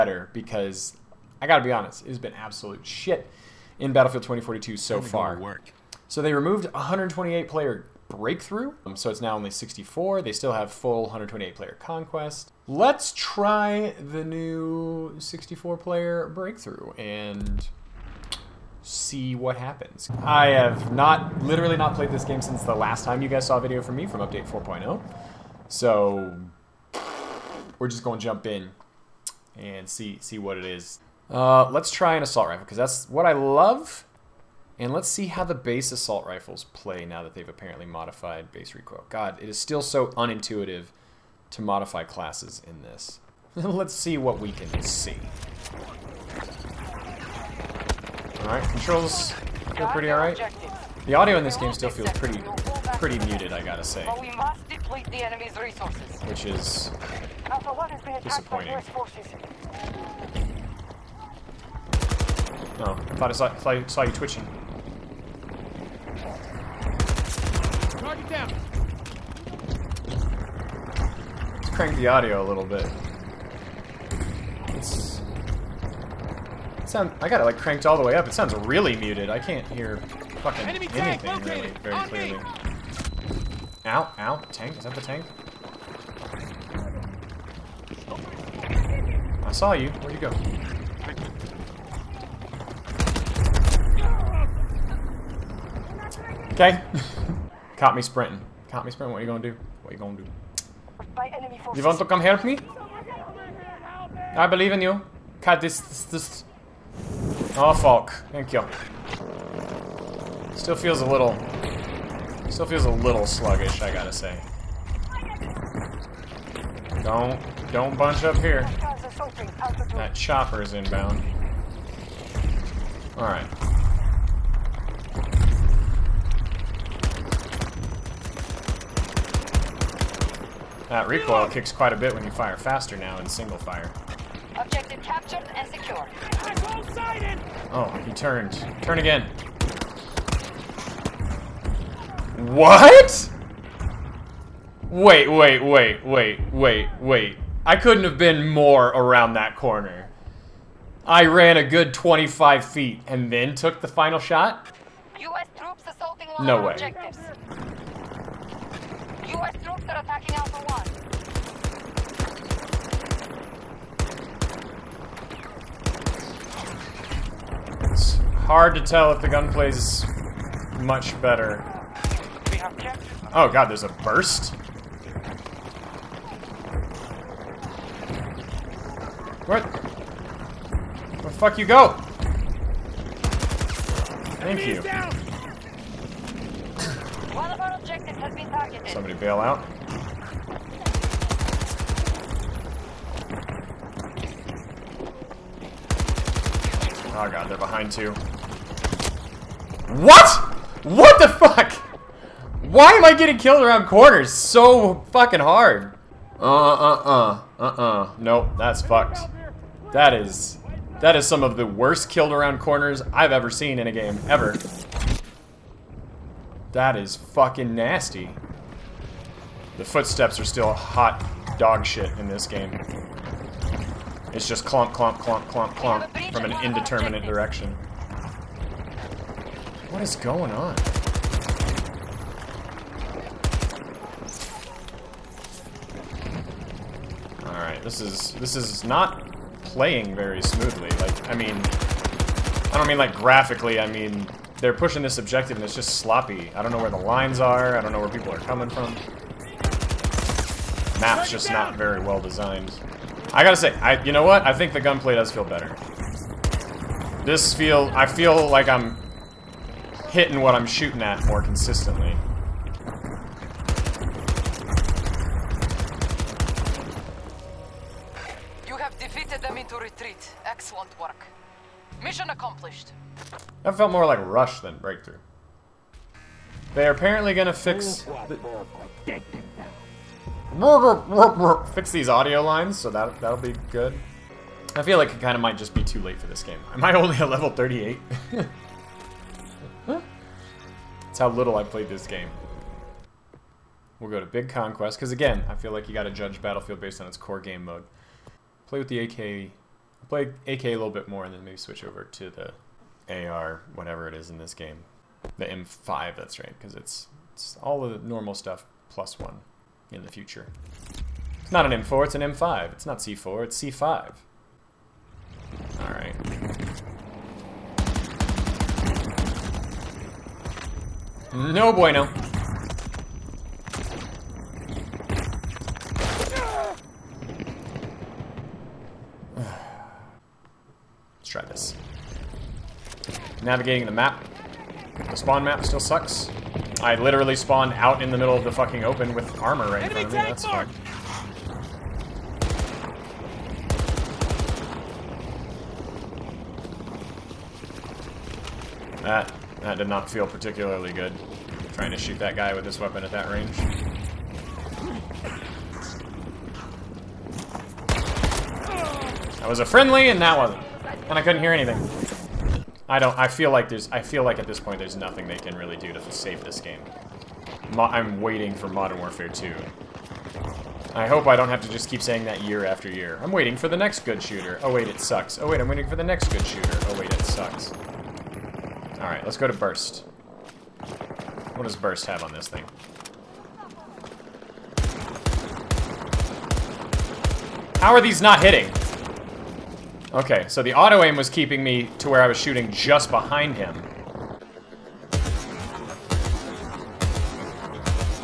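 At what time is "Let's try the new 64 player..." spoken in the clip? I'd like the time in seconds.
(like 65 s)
12 s.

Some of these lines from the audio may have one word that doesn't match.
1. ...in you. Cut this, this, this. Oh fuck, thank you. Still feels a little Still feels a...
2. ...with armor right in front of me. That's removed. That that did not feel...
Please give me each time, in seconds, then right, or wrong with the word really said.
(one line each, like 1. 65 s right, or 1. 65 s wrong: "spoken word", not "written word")
1. 104 s right
2. 339 s wrong: "fucked", not "removed".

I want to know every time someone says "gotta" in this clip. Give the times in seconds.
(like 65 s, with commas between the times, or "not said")
1 s, 53 s, 113 s, 253 s, 295 s.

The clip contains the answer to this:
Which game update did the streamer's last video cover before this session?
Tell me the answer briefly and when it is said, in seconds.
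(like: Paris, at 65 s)
4.0, at 24 s.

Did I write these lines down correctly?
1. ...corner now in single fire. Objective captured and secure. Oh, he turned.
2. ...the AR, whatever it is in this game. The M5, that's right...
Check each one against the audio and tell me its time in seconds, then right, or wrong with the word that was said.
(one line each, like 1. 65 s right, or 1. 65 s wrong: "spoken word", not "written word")
1. 132 s wrong: "faster", not "corner"
2. 302 s right.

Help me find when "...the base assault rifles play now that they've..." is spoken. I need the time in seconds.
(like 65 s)
35 s.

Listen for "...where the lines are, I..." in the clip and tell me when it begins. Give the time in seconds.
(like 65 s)
246 s.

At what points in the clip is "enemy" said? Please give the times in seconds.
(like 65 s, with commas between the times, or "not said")
55 s, 80 s.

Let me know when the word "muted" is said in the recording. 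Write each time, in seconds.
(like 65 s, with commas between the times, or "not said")
53 s, 78 s.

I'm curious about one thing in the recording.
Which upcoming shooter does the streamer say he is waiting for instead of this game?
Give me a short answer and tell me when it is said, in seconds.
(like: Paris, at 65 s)
Modern Warfare 2, at 368 s.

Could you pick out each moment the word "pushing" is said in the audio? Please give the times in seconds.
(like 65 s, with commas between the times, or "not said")
244 s.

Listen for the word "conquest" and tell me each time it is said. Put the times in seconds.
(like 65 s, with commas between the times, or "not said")
11 s, 294 s.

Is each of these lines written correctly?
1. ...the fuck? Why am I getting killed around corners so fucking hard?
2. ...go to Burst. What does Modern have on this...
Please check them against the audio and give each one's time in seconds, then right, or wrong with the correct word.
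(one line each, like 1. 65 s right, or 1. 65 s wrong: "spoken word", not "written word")
1. 201 s right
2. 379 s wrong: "Burst", not "Modern".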